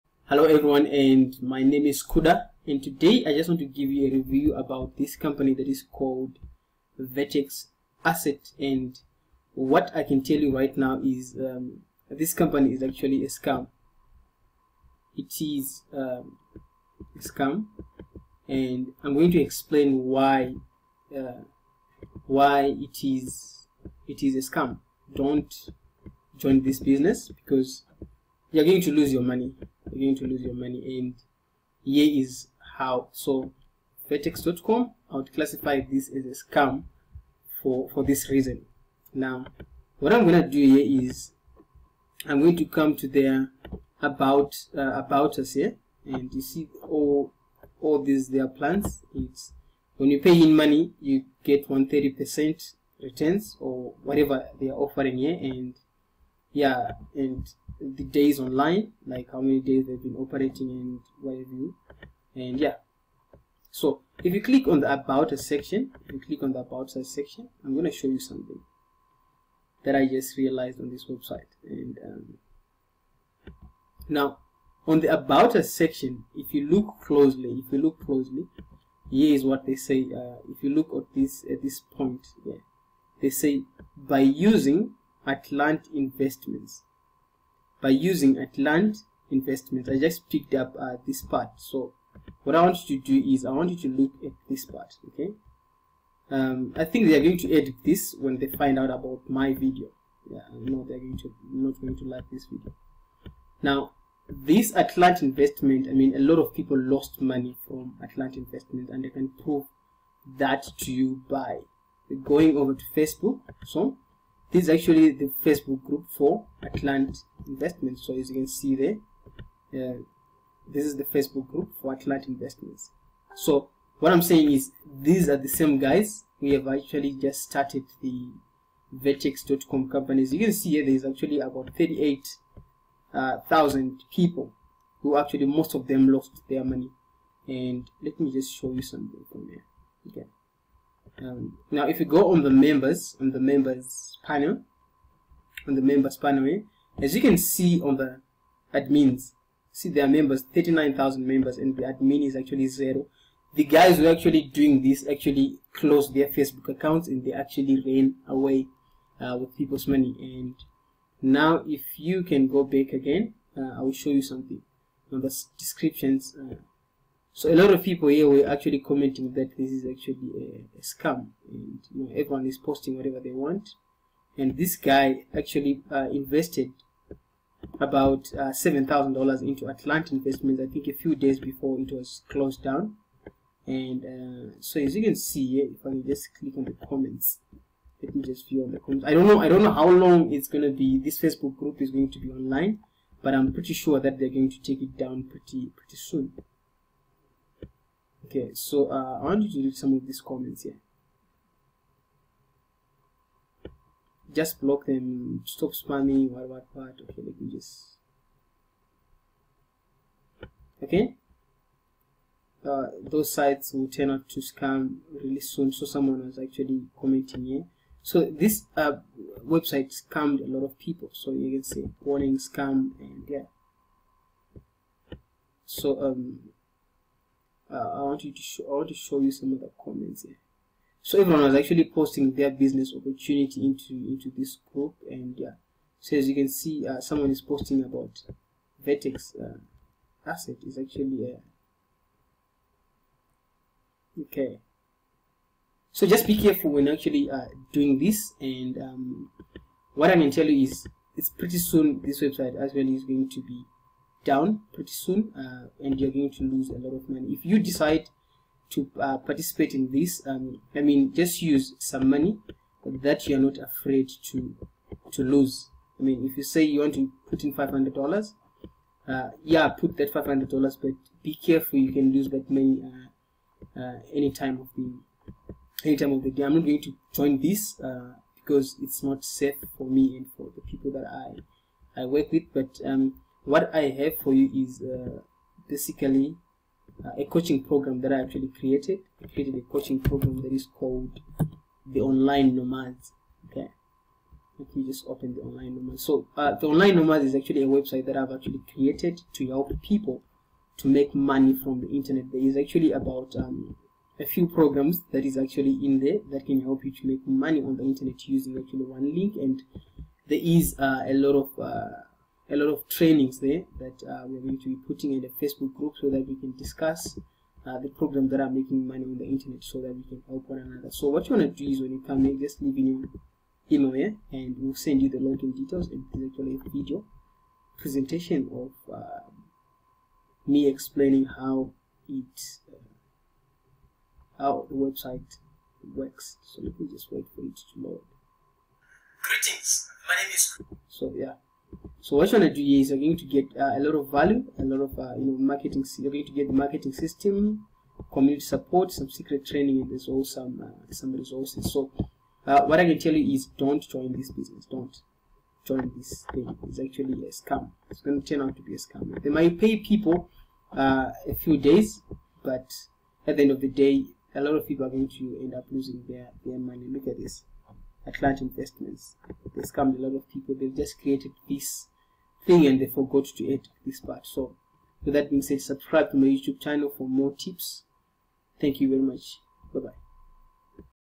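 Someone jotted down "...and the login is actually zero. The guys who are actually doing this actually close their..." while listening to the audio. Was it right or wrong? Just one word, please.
wrong.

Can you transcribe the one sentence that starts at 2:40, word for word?
And now, if you can go back again, uh, I will show you something on the descriptions.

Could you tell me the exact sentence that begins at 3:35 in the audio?
So someone was actually commenting here.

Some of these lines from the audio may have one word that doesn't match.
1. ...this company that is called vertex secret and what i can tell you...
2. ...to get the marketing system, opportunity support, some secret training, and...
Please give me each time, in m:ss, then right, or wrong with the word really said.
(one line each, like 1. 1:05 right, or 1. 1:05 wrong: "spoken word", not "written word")
1. 0:04 wrong: "asset", not "secret"
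2. 5:46 wrong: "community", not "opportunity".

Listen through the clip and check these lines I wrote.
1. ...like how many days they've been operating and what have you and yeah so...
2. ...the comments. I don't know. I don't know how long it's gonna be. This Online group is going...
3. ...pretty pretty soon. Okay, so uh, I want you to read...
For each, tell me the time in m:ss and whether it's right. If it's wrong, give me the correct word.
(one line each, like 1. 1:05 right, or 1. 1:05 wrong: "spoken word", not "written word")
1. 0:59 right
2. 3:08 wrong: "Facebook", not "Online"
3. 3:15 right.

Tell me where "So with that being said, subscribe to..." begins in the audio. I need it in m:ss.
6:14.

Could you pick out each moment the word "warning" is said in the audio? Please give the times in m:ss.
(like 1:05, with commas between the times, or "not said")
3:42.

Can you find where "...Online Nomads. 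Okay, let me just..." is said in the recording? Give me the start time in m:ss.
4:52.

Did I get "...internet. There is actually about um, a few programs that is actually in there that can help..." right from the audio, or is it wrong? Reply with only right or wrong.
right.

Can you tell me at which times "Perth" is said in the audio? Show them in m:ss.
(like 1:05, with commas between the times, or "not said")
not said.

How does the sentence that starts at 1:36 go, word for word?
Um, I think they are going to edit this when they find out about my video.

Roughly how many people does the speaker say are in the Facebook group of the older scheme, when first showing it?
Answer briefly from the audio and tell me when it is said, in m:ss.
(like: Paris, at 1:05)
38,000, at 2:11.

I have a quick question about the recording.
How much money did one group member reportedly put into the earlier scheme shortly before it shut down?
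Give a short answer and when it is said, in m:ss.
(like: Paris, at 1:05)
7,000 dollars, at 2:58.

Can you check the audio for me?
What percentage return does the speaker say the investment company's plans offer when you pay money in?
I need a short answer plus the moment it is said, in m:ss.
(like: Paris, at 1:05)
130 percent, at 0:51.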